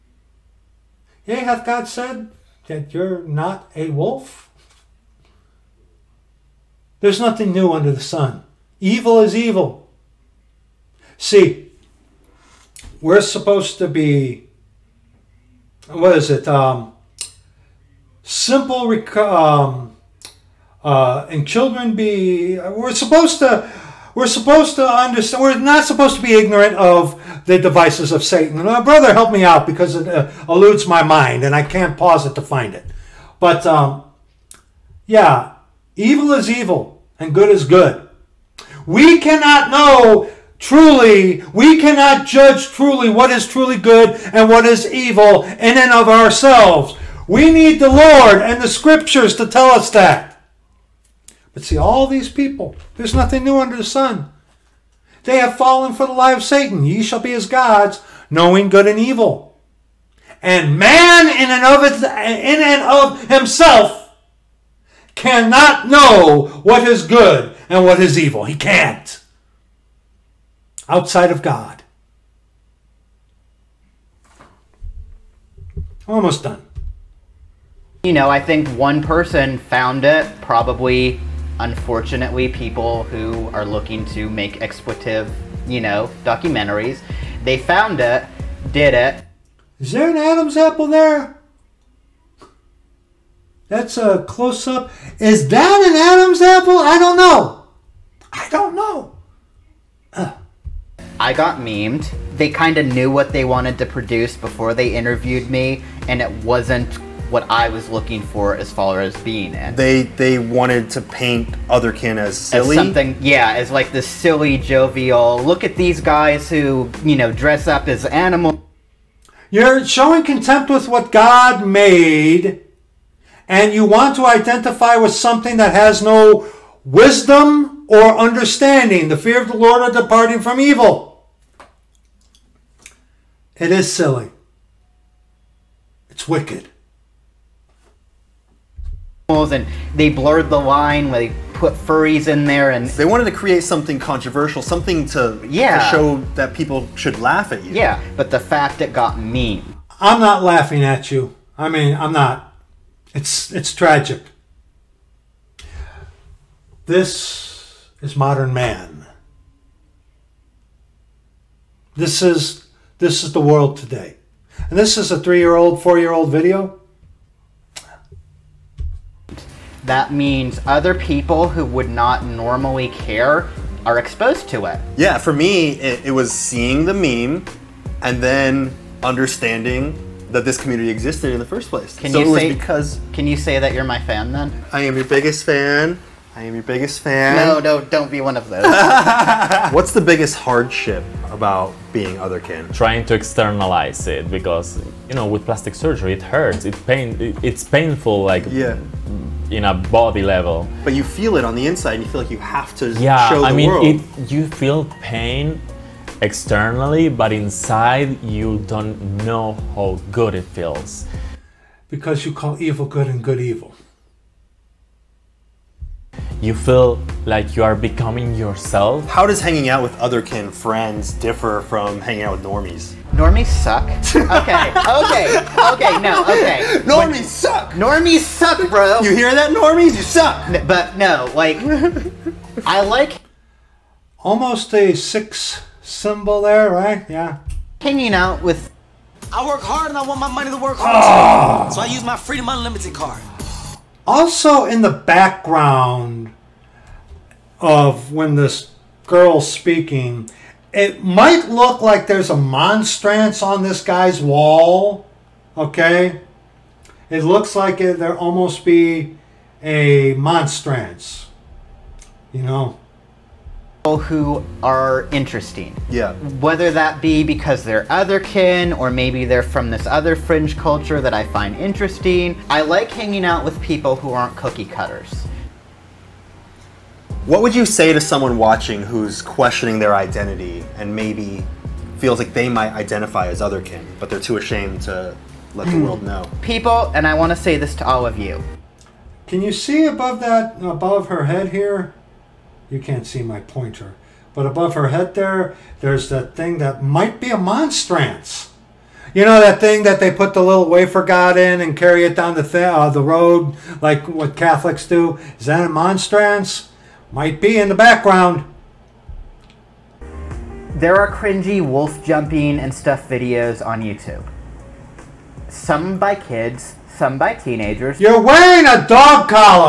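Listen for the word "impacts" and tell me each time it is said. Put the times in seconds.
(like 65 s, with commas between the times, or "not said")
not said.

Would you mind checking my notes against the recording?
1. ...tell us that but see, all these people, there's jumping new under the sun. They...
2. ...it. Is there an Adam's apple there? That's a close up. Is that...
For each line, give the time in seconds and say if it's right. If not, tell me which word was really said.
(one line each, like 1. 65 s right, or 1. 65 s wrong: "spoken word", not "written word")
1. 49 s wrong: "nothing", not "jumping"
2. 88 s right.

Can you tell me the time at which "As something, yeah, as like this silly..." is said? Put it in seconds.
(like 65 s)
112 s.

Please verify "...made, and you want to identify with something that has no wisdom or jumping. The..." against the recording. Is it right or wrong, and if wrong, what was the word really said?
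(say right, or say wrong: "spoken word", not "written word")
wrong: "understanding", not "jumping".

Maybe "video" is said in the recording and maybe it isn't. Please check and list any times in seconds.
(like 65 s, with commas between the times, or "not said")
166 s, 313 s.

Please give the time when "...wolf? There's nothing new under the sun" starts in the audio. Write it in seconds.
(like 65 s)
3 s.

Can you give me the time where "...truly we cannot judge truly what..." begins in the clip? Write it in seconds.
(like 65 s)
40 s.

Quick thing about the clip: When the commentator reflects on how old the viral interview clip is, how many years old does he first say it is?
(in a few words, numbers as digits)
3.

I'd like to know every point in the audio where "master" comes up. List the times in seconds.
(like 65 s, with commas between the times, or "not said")
not said.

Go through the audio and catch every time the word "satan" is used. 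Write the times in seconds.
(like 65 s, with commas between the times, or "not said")
28 s, 56 s.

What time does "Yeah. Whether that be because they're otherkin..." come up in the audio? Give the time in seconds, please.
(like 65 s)
265 s.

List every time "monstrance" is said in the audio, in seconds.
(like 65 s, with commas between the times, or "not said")
252 s, 260 s, 297 s, 305 s.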